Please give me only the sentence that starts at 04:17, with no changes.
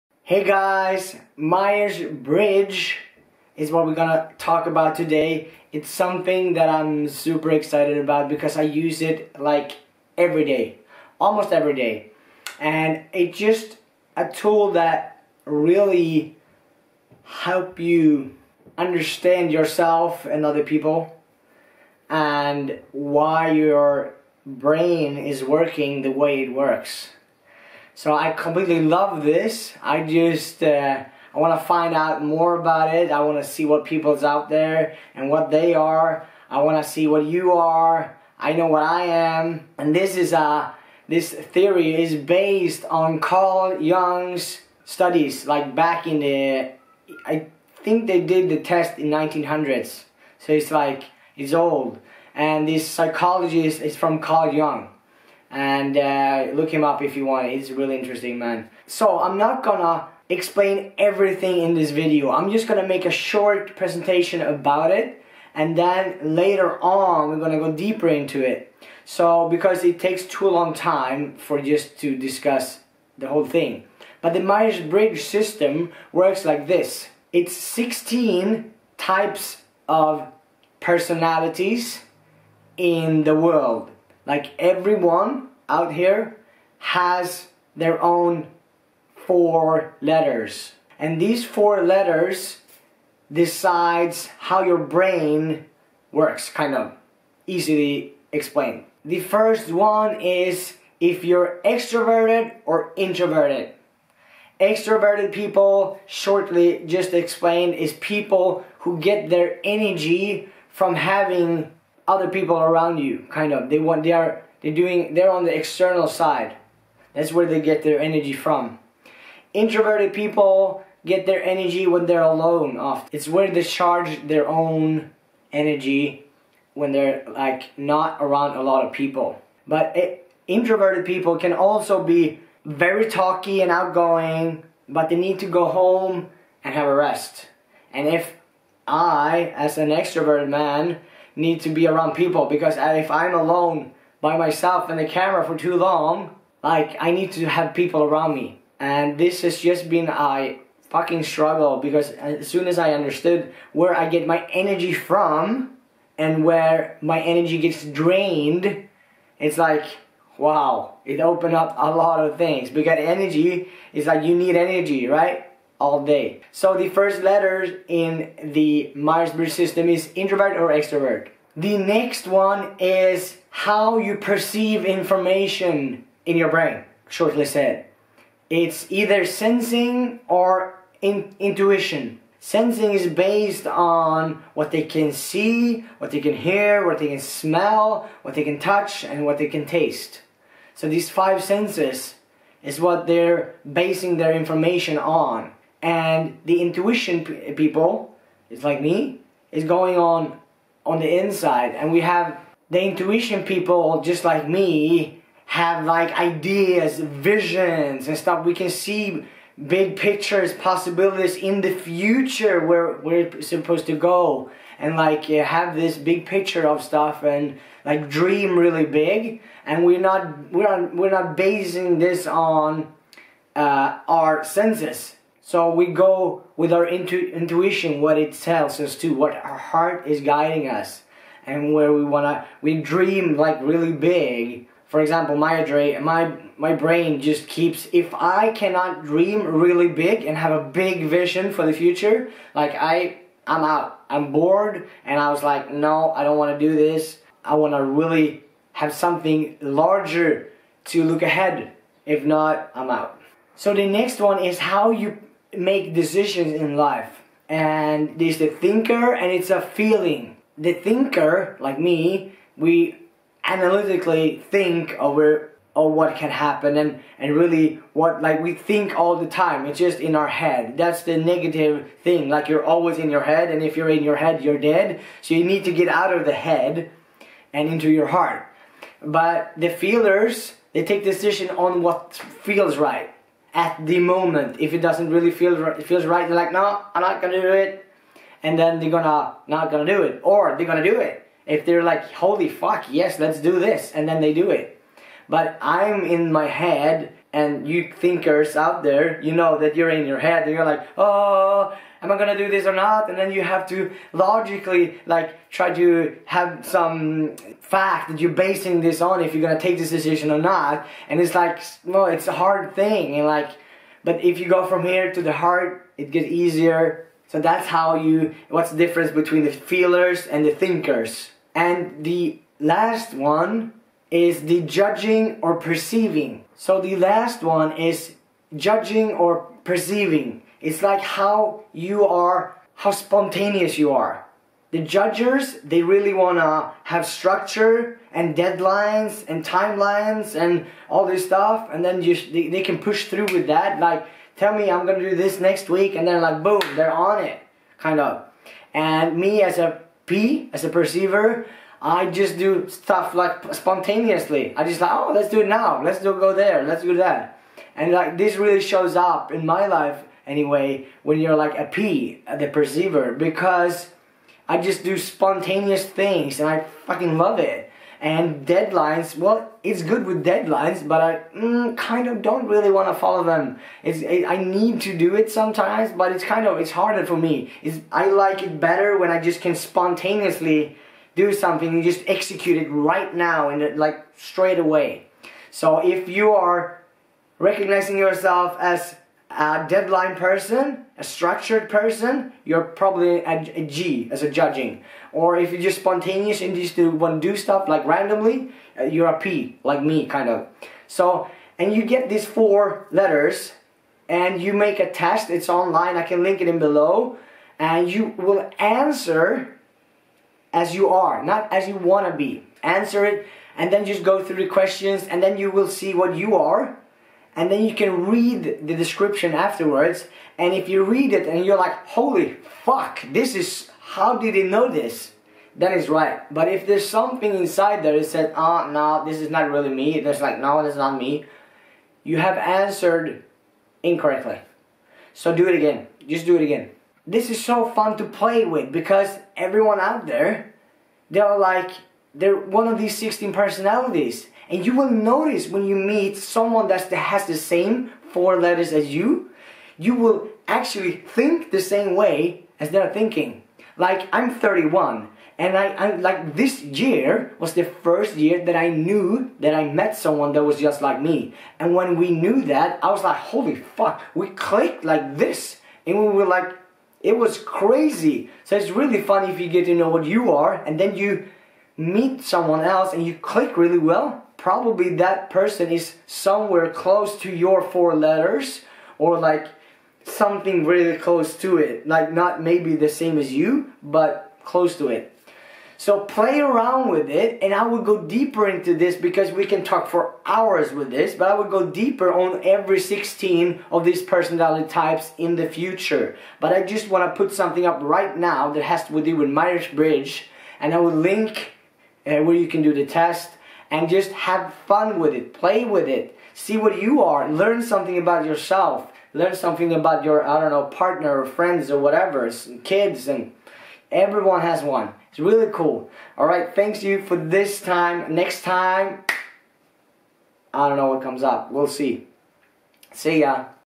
And there's the thinker and it's a feeling.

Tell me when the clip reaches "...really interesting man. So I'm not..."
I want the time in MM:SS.
00:57.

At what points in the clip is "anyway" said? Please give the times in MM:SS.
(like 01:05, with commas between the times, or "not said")
06:00.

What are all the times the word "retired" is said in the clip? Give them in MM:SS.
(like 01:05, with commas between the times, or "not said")
not said.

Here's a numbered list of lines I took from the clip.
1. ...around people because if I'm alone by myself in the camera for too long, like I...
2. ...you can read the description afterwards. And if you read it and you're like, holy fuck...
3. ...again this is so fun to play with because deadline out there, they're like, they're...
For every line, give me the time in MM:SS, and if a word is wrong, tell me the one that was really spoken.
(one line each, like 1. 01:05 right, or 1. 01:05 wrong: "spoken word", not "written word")
1. 02:21 right
2. 06:57 right
3. 07:16 wrong: "everyone", not "deadline".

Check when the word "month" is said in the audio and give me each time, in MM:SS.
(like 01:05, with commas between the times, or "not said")
not said.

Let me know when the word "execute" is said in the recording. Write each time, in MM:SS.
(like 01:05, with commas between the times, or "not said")
06:22.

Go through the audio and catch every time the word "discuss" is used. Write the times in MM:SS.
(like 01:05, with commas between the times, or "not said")
01:12.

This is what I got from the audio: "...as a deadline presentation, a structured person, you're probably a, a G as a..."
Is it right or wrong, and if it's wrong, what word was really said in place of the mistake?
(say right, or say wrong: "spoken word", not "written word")
wrong: "person", not "presentation".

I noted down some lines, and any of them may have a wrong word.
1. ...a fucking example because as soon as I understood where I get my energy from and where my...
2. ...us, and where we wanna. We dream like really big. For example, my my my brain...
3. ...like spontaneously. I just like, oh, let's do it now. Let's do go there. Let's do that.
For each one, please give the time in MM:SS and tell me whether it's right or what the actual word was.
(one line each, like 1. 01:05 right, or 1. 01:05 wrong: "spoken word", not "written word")
1. 02:30 wrong: "struggle", not "example"
2. 03:50 right
3. 05:53 right.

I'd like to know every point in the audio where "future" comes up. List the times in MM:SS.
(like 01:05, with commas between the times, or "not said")
03:31, 04:01, 08:15.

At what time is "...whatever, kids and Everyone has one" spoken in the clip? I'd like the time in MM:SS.
08:31.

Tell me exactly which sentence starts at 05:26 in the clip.
So the last one is judging or perceiving.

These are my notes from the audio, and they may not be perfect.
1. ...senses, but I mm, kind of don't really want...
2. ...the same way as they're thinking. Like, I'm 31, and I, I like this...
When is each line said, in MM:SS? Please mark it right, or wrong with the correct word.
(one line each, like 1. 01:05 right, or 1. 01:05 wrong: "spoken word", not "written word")
1. 06:10 wrong: "deadlines", not "senses"
2. 07:31 right.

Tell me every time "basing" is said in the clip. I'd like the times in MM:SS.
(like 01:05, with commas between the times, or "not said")
03:13, 03:41, 05:08.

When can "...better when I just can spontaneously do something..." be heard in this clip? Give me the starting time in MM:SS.
06:18.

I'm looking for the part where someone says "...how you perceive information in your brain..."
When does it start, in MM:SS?
02:53.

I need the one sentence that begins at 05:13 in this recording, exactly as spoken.
And like, but if you go from here to the heart, it gets easier.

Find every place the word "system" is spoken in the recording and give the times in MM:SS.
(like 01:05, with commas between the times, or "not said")
01:15, 02:49.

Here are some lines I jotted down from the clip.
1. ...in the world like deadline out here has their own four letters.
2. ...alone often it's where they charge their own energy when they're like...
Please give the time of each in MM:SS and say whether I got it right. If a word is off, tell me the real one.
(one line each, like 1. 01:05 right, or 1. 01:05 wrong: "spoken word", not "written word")
1. 01:22 wrong: "everyone", not "deadline"
2. 02:02 right.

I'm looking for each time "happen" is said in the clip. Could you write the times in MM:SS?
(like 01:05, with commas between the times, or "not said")
04:26.